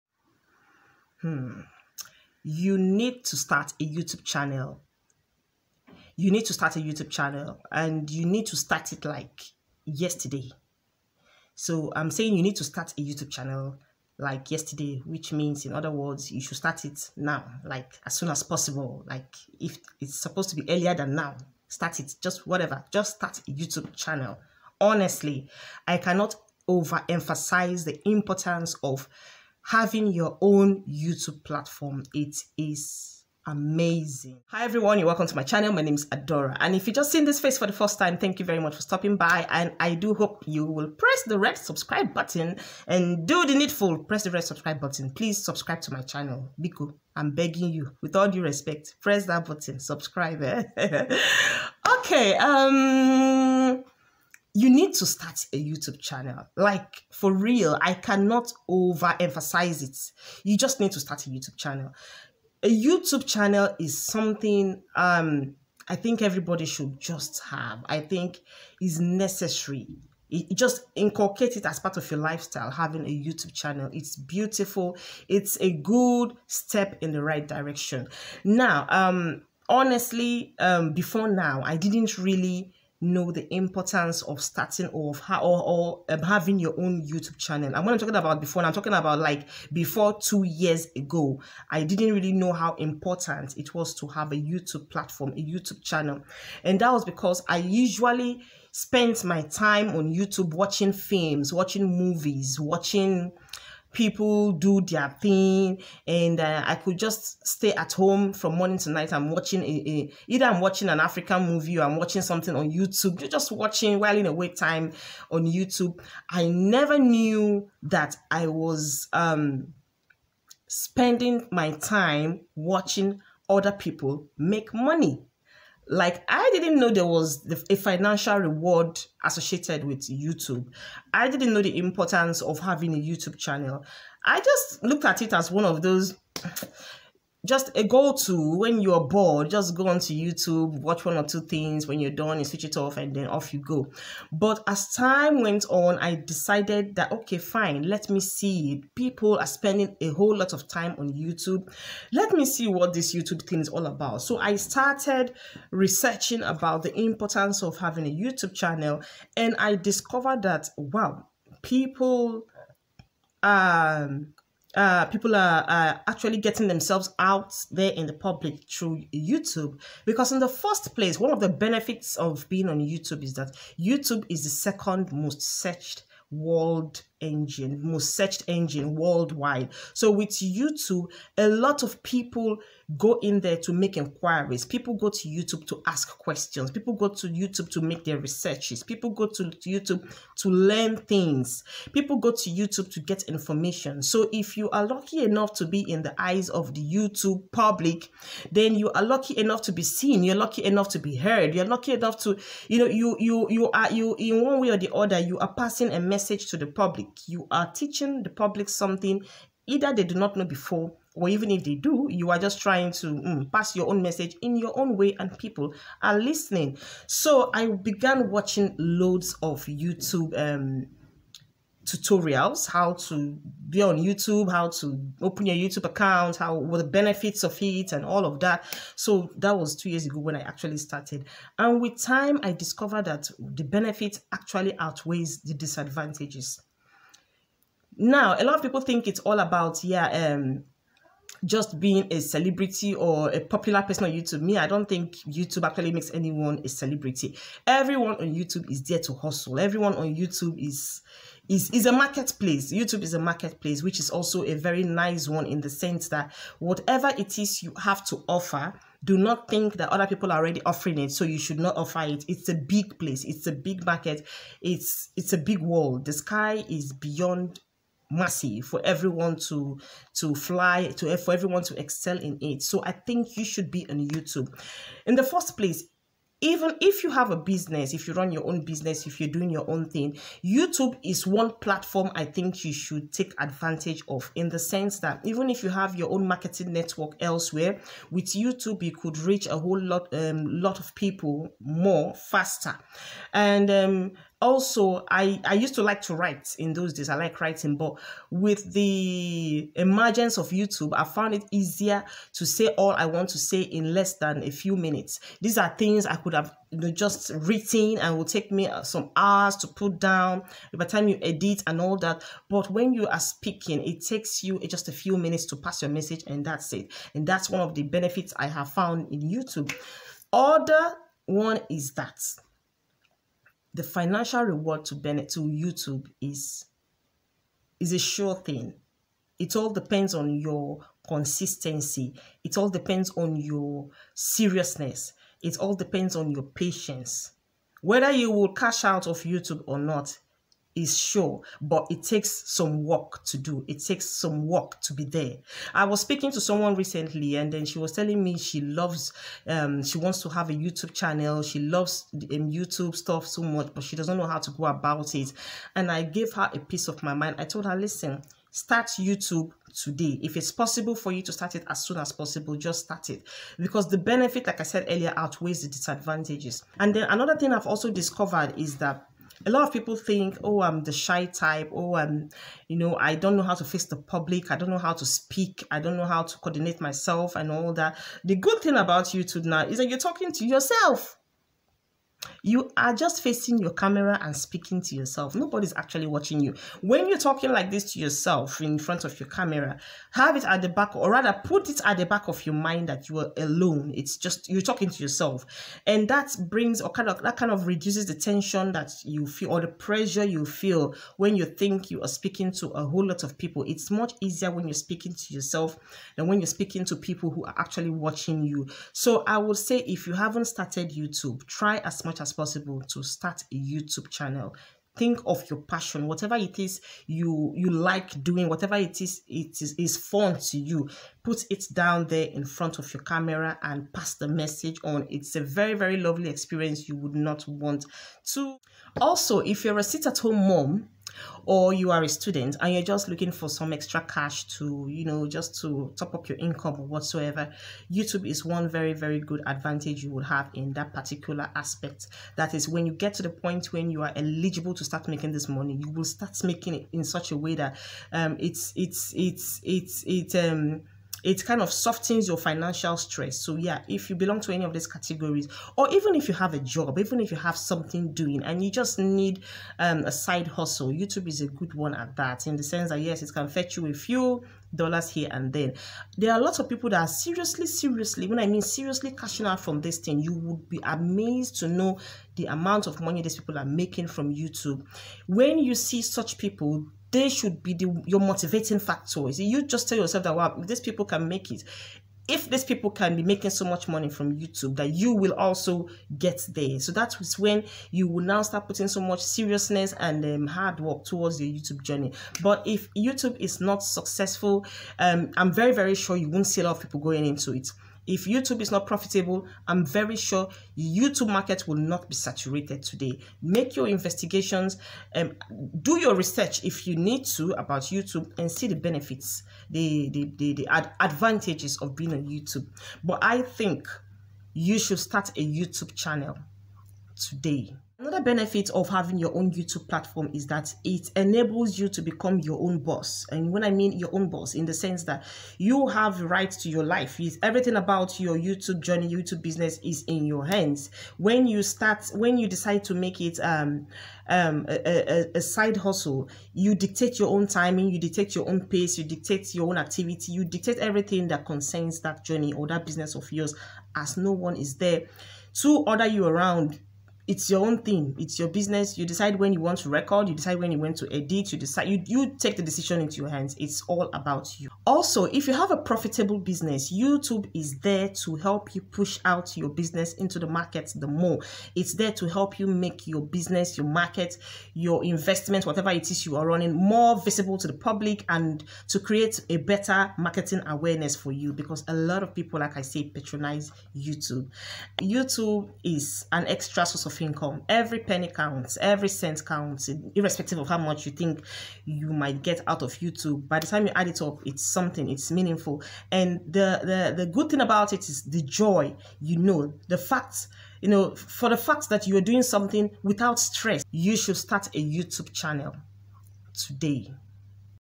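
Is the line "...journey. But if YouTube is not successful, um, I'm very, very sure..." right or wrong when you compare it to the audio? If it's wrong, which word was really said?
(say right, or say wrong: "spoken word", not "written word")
right.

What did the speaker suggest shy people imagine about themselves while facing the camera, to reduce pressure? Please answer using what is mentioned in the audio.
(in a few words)
that you are alone.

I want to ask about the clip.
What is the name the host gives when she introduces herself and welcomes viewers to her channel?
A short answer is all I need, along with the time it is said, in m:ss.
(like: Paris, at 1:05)
Adora, at 0:36.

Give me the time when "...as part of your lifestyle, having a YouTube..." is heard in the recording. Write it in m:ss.
1:11.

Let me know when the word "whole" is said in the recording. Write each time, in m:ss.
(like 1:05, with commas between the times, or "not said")
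2:30, 4:49, 6:42.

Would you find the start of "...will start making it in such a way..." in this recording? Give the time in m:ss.
7:25.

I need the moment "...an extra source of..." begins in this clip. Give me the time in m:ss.
9:36.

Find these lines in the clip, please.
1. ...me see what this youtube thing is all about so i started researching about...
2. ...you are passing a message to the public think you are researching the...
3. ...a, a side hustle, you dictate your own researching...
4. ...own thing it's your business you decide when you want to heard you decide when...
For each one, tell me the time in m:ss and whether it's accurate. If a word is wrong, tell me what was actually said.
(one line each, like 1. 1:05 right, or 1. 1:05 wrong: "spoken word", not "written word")
1. 2:32 right
2. 3:25 wrong: "teaching", not "researching"
3. 8:54 wrong: "timing", not "researching"
4. 9:07 wrong: "record", not "heard".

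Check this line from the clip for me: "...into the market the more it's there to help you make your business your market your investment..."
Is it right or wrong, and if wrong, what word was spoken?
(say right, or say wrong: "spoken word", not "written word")
right.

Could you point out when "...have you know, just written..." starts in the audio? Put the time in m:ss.
5:06.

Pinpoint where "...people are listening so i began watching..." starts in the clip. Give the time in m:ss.
3:35.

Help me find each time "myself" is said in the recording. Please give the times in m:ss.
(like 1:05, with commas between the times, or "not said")
6:16.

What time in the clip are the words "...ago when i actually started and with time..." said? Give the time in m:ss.
3:50.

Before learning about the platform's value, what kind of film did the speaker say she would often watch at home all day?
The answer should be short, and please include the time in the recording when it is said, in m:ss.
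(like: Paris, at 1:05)
African movie, at 1:50.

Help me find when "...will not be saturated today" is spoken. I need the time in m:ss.
8:21.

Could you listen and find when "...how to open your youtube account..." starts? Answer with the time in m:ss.
3:44.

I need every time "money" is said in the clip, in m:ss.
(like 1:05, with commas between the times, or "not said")
2:04, 7:25, 7:52, 8:03.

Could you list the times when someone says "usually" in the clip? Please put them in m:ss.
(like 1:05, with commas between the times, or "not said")
1:37.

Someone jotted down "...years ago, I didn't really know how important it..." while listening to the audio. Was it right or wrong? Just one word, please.
right.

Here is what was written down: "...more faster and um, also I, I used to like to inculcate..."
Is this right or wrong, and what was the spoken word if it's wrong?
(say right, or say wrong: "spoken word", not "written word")
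wrong: "write", not "inculcate".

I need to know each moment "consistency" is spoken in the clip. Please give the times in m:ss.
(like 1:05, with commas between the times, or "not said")
5:31.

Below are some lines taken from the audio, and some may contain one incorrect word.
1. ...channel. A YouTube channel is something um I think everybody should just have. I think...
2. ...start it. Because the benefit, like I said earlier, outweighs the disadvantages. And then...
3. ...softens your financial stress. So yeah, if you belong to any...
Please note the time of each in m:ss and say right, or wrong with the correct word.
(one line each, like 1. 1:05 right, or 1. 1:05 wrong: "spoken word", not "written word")
1. 1:01 right
2. 6:02 right
3. 7:31 right.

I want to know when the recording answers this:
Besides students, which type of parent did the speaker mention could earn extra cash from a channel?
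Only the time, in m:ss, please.
7:09.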